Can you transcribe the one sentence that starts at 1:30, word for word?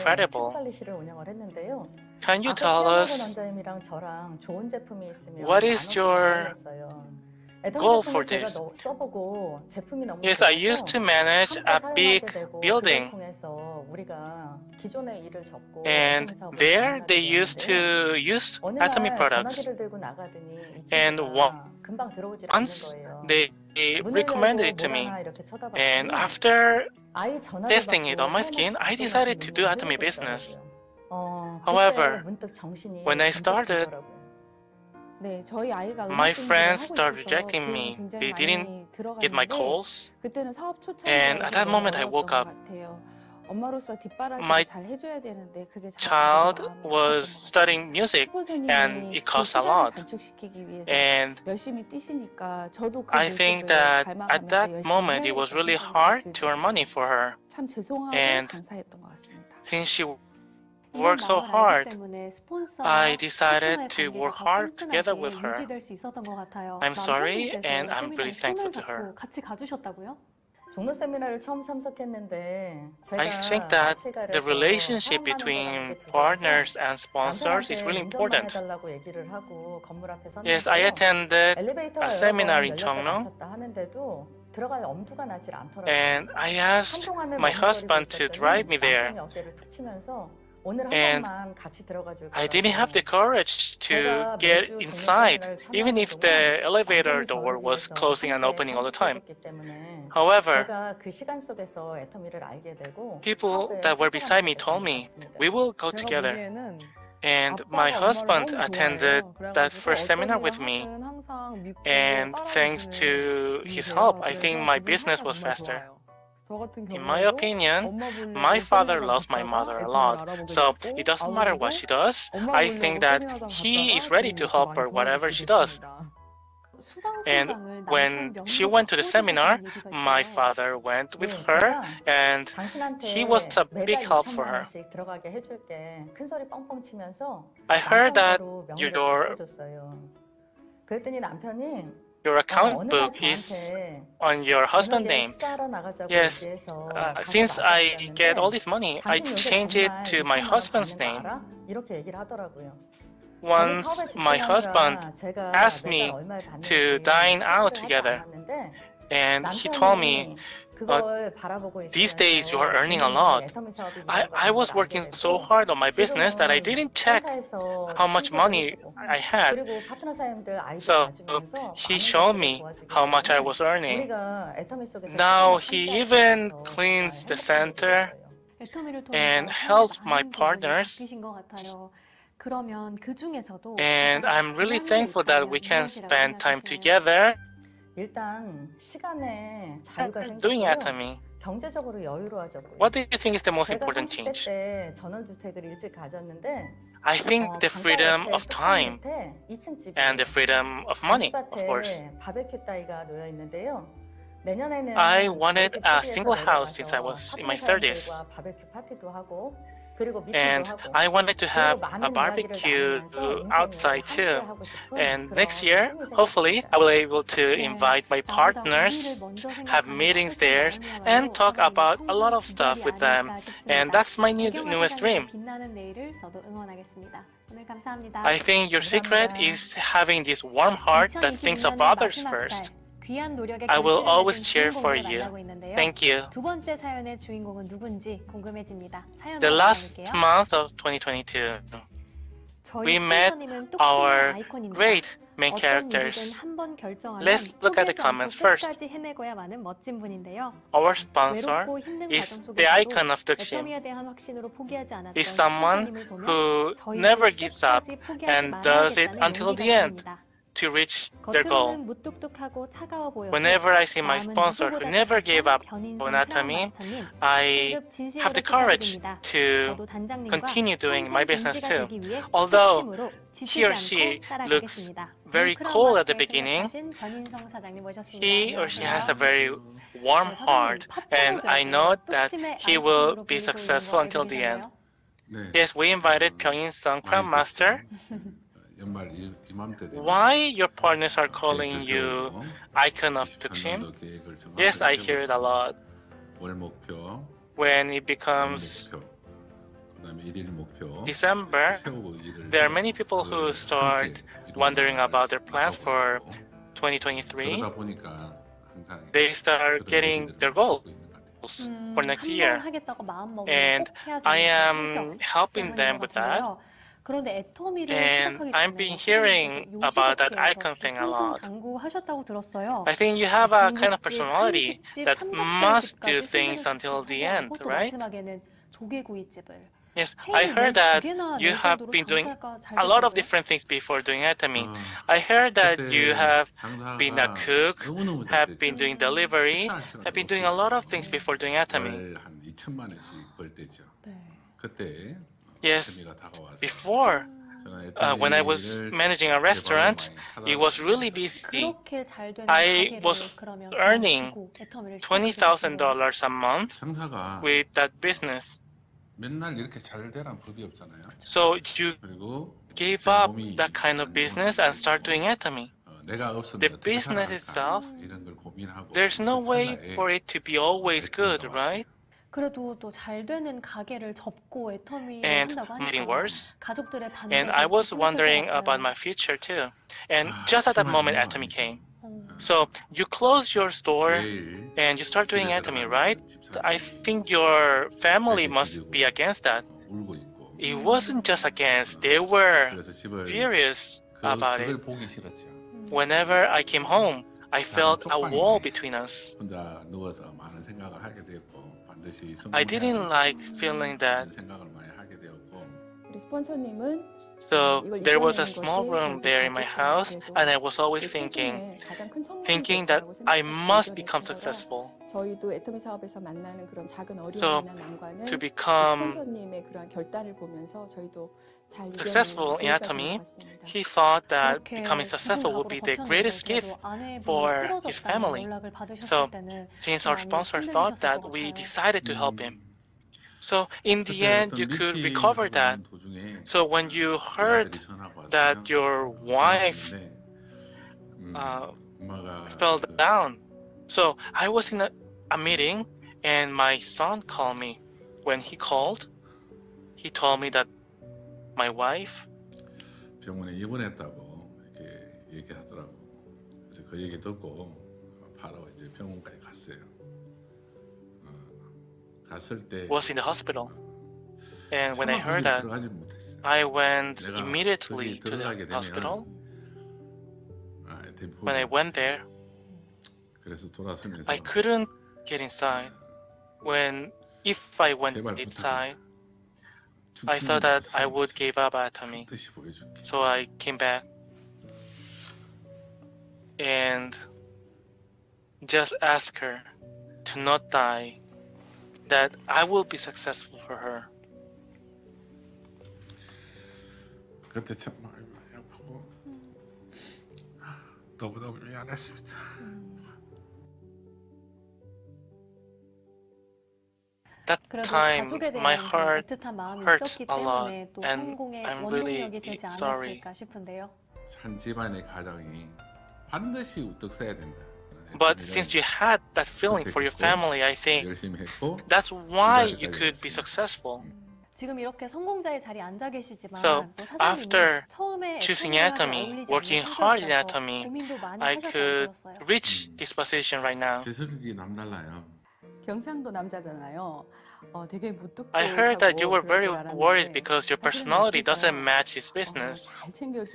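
And I didn't have the courage to get inside, even if the elevator door was closing and opening all the time.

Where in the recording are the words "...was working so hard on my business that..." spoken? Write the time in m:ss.
2:44.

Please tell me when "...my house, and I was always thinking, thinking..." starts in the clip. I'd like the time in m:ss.
6:49.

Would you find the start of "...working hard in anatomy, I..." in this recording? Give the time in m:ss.
8:49.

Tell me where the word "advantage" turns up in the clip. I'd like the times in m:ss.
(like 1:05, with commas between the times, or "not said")
not said.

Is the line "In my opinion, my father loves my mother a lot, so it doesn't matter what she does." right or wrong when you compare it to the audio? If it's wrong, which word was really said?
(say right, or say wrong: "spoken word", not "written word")
right.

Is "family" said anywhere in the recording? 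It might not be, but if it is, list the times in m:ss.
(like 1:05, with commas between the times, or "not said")
6:27, 7:07, 8:40.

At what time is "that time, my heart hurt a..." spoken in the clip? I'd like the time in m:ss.
8:27.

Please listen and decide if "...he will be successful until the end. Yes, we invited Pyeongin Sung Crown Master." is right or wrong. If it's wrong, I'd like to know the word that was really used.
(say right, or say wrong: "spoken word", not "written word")
right.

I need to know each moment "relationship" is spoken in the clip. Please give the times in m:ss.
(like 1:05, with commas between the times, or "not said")
1:14.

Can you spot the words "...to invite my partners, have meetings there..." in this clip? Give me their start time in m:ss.
3:37.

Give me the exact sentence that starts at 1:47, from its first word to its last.
And my husband attended that first seminar with me.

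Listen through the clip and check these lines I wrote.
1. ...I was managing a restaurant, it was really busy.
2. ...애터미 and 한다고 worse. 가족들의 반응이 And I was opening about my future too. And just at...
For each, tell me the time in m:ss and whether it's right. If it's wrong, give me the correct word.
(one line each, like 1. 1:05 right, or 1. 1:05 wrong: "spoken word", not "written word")
1. 5:48 right
2. 6:14 wrong: "wondering", not "opening".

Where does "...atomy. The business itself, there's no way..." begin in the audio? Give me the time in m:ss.
6:05.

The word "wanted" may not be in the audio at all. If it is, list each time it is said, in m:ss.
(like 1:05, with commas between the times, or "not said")
3:25, 3:31.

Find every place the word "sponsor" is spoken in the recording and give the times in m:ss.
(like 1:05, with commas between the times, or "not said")
1:16, 4:10, 4:24, 7:10.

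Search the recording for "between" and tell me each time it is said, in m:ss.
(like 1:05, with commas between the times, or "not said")
1:15, 6:38.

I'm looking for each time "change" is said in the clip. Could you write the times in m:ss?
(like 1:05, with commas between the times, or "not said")
2:29, 3:14.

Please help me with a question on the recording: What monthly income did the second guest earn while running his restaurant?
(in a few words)
$20,000.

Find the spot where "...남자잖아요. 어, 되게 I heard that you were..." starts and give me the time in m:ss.
8:56.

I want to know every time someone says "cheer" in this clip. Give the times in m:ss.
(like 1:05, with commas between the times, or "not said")
3:54.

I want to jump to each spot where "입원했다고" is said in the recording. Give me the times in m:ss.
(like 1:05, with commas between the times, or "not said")
7:33.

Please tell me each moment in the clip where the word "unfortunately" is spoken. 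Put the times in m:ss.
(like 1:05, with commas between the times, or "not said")
not said.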